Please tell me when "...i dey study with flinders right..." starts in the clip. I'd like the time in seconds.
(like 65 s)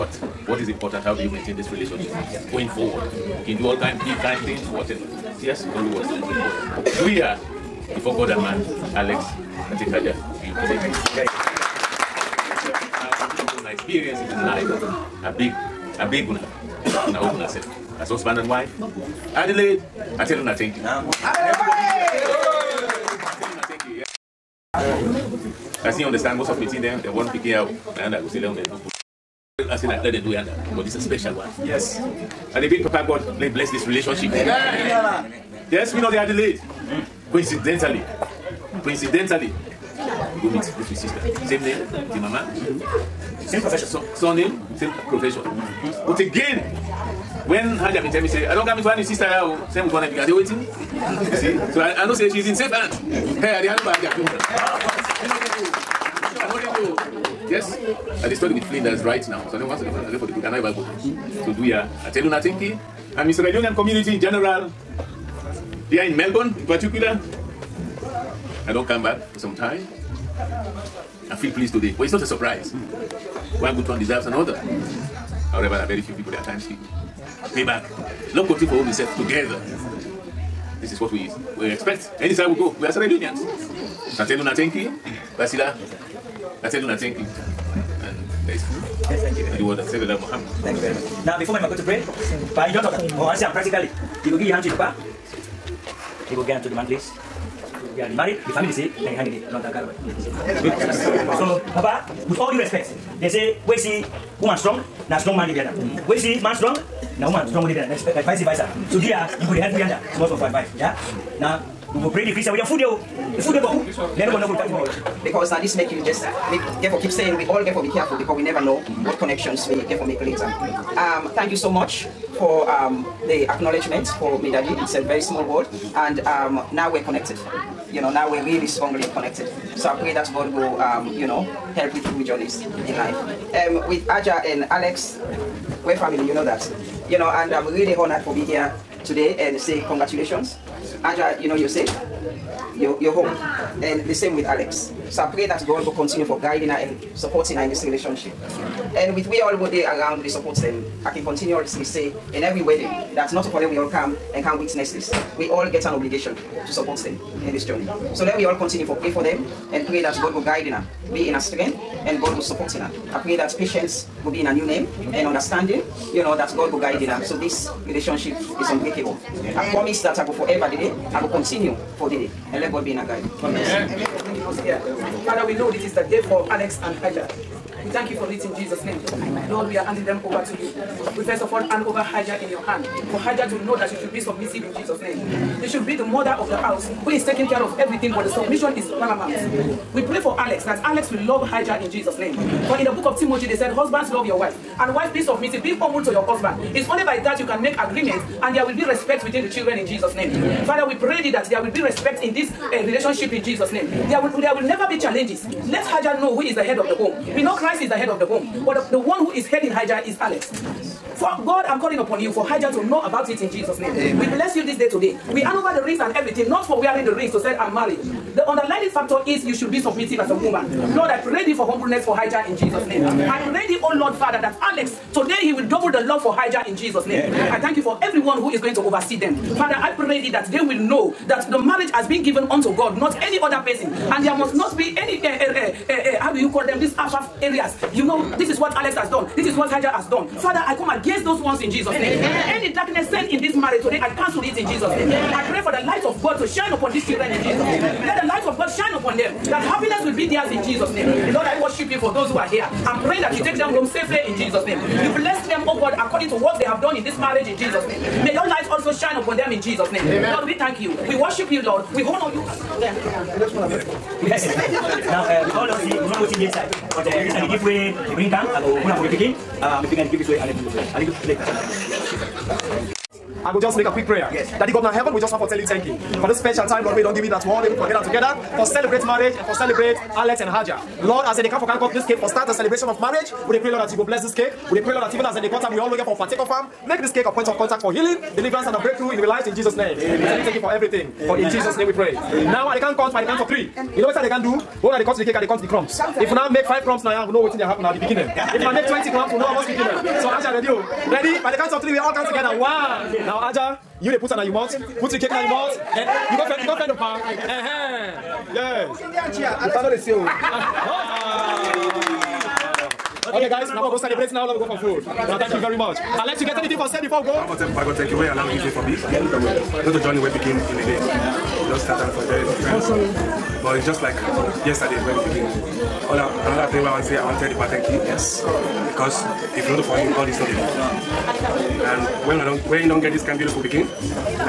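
58 s.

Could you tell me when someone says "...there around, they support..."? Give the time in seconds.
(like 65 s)
149 s.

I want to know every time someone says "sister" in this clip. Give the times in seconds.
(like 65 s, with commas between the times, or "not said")
40 s, 49 s.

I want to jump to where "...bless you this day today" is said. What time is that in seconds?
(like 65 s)
214 s.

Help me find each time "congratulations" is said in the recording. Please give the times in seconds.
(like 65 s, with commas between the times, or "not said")
139 s.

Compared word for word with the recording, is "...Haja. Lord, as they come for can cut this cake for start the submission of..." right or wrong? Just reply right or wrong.
wrong.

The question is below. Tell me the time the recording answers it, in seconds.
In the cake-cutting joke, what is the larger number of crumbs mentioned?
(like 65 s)
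298 s.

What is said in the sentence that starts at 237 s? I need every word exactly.
You know, this is what Alex has done.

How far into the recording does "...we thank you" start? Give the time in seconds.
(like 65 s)
260 s.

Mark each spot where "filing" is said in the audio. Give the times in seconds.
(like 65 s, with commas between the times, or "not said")
not said.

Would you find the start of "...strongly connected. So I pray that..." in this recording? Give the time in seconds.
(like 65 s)
128 s.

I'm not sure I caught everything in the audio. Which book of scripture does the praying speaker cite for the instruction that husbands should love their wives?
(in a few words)
Timothy.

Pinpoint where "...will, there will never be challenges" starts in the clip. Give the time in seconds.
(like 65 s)
204 s.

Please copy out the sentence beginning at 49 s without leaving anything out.
say mo because they i say you see so i i know say she is in safe hands.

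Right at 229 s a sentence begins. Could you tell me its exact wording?
Father, I pray thee that they will know that the marriage has been given unto God, not any other person.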